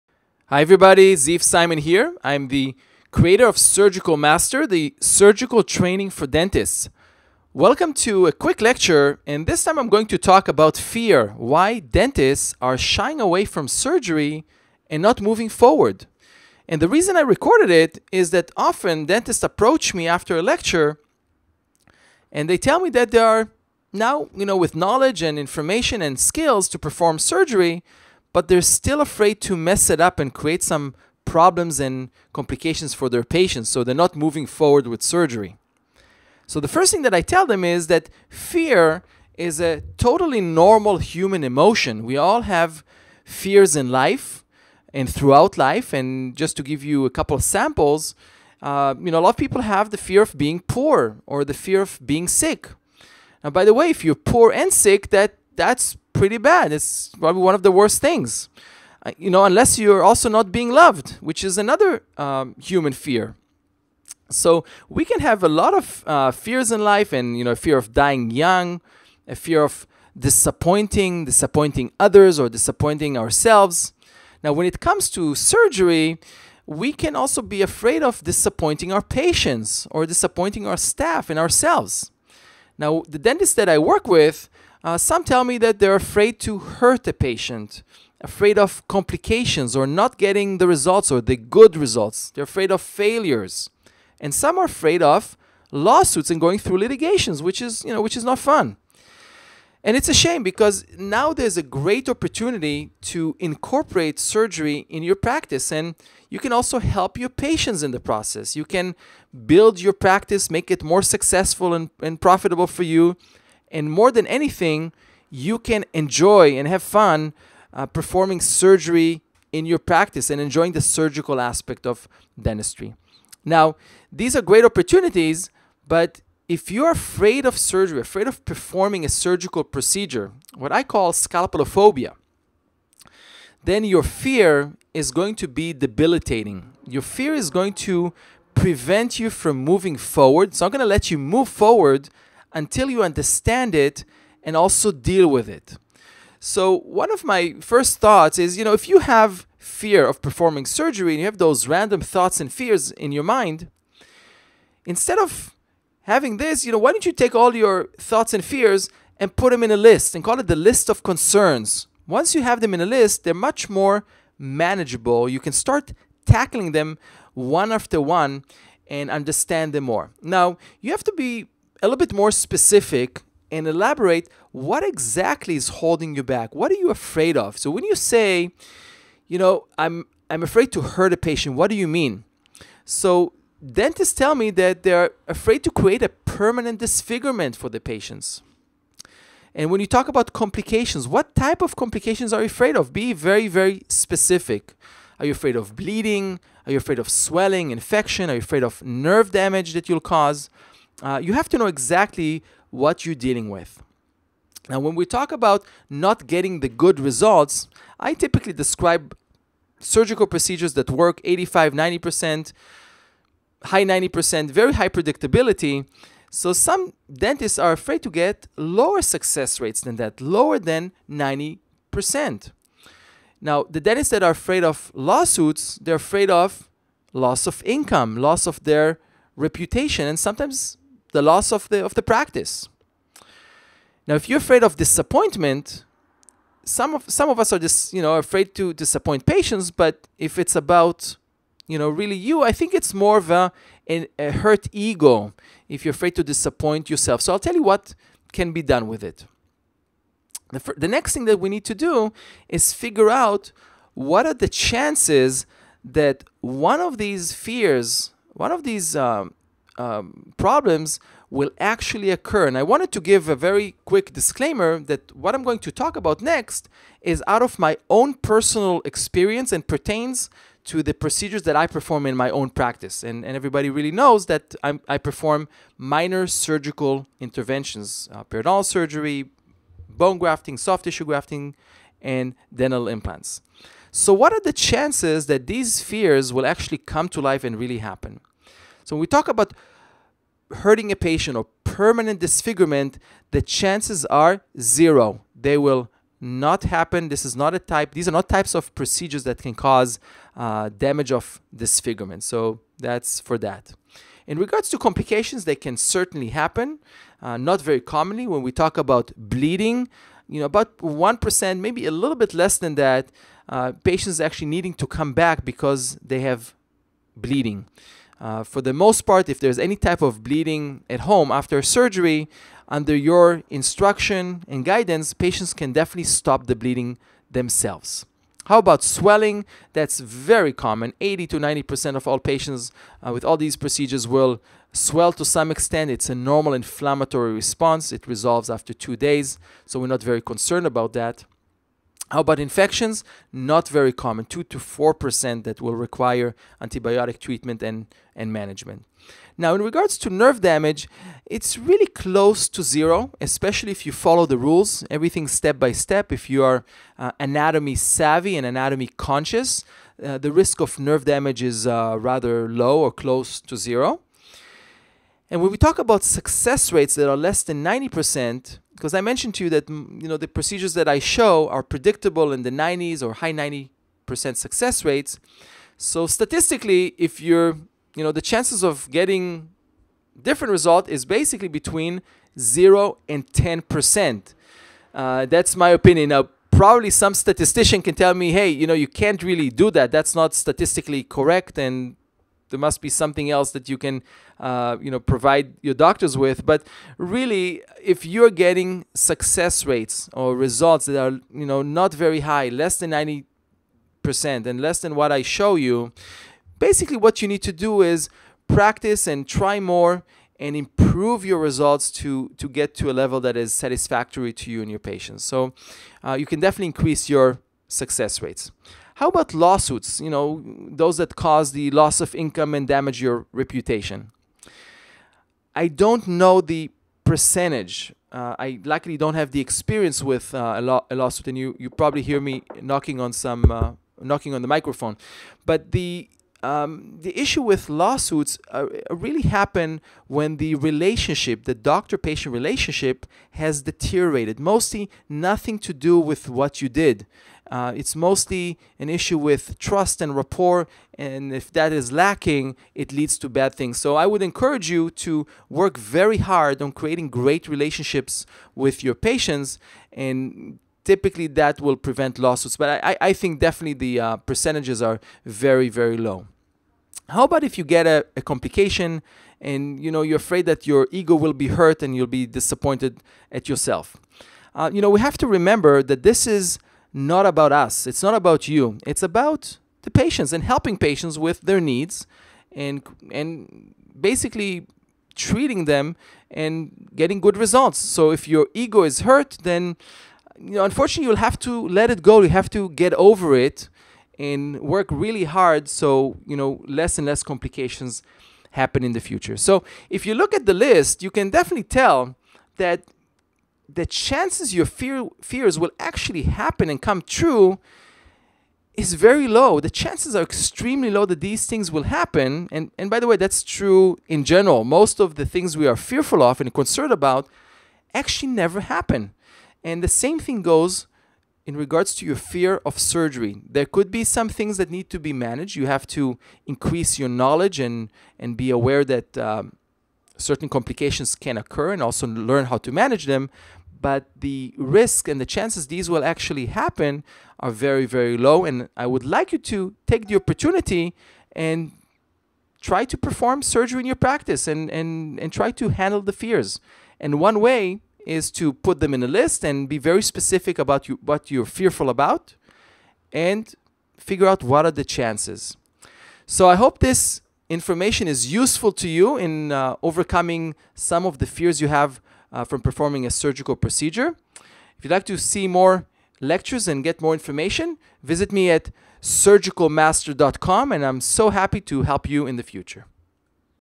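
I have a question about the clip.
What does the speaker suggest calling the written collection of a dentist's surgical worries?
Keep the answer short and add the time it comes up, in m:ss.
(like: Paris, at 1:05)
list of concerns, at 2:40.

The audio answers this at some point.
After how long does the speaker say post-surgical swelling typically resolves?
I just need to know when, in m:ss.
5:38.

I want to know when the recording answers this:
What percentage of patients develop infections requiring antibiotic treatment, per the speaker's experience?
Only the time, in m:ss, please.
5:44.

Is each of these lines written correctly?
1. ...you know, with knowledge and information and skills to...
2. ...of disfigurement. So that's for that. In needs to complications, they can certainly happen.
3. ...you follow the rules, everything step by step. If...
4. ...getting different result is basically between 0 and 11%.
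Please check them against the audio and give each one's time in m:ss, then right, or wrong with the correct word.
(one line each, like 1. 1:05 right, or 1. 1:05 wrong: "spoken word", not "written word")
1. 0:24 right
2. 5:01 wrong: "regards", not "needs"
3. 5:53 right
4. 6:18 wrong: "10", not "11".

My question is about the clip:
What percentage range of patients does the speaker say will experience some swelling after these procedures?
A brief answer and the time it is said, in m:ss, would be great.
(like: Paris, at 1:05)
80 to 90%, at 5:31.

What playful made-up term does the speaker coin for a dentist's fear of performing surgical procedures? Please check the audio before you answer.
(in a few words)
scalpelophobia.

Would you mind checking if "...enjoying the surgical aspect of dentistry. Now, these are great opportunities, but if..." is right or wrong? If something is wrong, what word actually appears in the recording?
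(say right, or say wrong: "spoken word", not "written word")
right.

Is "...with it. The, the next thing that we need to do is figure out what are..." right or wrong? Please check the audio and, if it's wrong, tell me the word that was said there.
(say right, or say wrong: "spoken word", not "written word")
right.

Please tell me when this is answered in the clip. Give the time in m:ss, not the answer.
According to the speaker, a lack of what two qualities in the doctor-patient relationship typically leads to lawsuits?
7:29.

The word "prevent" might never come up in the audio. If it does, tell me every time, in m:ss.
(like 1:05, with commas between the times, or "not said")
2:18, 7:41.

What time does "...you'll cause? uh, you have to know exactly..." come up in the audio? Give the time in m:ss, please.
3:19.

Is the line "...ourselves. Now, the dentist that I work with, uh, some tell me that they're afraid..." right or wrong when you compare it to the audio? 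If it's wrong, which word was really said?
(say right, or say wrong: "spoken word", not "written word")
right.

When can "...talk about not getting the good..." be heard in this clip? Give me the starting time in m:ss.
3:25.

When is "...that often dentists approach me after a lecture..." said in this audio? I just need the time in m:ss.
0:18.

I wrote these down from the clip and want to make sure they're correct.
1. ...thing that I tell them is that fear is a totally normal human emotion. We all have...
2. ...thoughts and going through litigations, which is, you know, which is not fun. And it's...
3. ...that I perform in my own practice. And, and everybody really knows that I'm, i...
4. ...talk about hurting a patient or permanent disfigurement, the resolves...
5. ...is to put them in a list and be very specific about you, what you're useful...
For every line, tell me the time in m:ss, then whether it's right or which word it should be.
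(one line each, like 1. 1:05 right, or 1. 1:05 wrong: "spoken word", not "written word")
1. 0:36 right
2. 1:35 wrong: "lawsuits", not "thoughts"
3. 4:31 right
4. 4:49 wrong: "chances", not "resolves"
5. 9:08 wrong: "fearful", not "useful".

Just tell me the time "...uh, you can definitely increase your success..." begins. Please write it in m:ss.
6:56.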